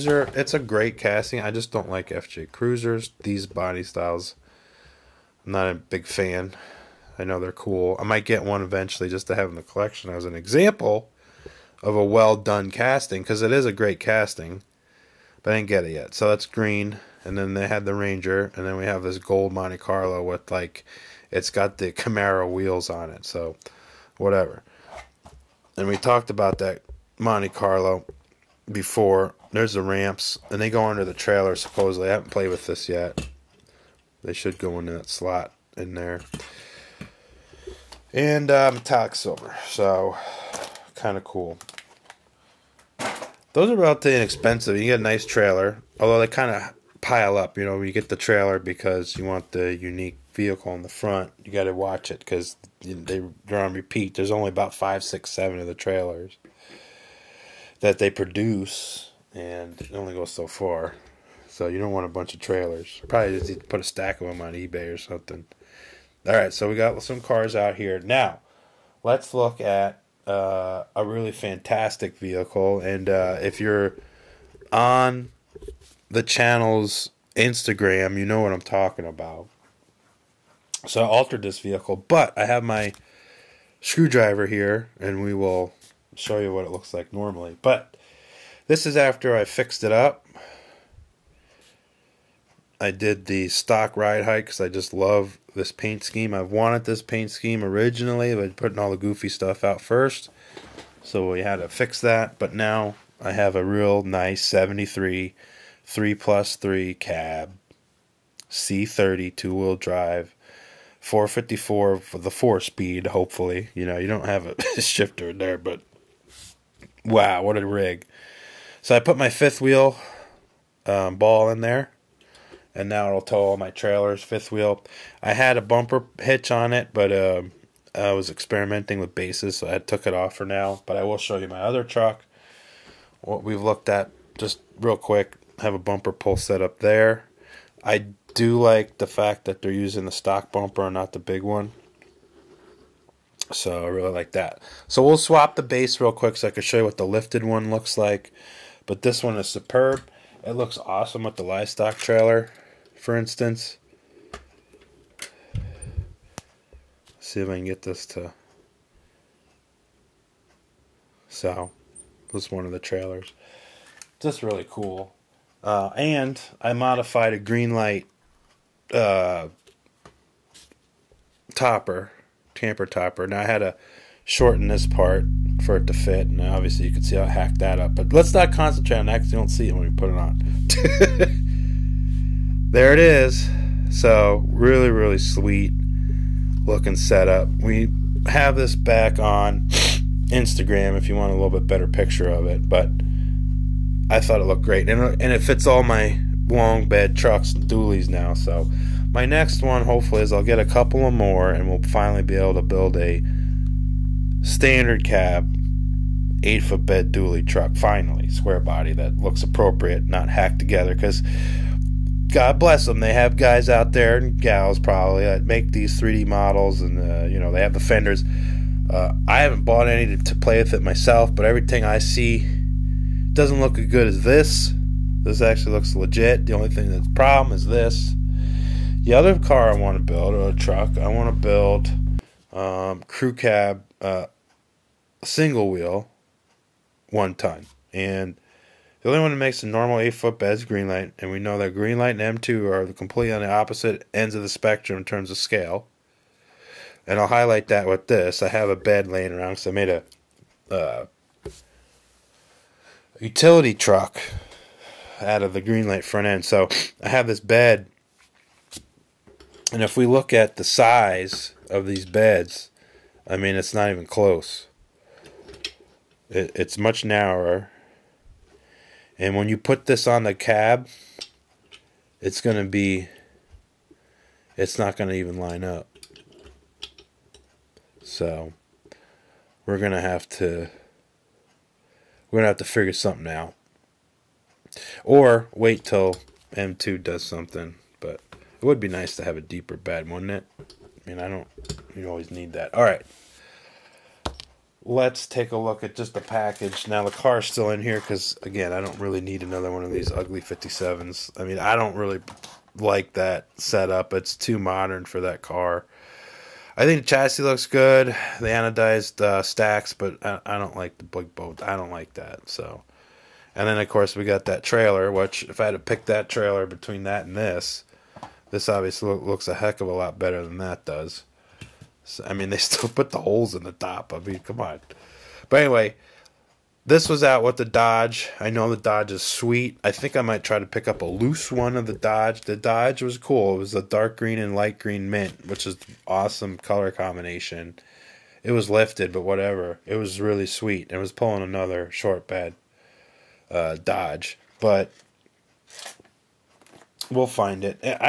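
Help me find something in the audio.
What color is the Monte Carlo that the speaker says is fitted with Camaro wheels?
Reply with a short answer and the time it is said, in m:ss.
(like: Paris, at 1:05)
Gold, at 0:19.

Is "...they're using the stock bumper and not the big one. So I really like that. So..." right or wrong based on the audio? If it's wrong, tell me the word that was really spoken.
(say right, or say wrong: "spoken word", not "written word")
right.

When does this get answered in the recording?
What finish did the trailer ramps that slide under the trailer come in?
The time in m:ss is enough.
0:38.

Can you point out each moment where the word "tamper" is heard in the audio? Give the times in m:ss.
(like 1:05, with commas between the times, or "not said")
2:52.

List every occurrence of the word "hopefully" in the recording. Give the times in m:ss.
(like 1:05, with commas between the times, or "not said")
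1:53, 3:19.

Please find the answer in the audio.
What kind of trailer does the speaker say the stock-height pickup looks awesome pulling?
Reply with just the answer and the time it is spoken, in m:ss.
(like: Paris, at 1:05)
Livestock trailer, at 2:31.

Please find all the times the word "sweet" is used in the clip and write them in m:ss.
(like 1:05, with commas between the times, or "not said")
3:05, 5:29, 5:40.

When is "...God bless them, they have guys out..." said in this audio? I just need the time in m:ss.
3:32.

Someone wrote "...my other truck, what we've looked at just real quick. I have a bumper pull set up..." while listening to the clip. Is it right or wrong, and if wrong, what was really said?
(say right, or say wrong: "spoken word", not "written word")
right.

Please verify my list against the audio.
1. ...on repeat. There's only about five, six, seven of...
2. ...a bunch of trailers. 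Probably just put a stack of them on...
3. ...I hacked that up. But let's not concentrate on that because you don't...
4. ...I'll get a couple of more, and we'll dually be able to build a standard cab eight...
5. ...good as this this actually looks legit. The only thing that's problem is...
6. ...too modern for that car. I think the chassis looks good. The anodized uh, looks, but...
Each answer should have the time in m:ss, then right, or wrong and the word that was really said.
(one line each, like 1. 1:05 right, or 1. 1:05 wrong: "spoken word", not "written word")
1. 0:53 right
2. 1:02 right
3. 2:57 right
4. 3:20 wrong: "finally", not "dually"
5. 3:43 right
6. 5:04 wrong: "stacks", not "looks".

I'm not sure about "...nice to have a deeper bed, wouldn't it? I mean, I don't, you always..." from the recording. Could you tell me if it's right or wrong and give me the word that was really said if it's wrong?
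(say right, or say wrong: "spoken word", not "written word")
right.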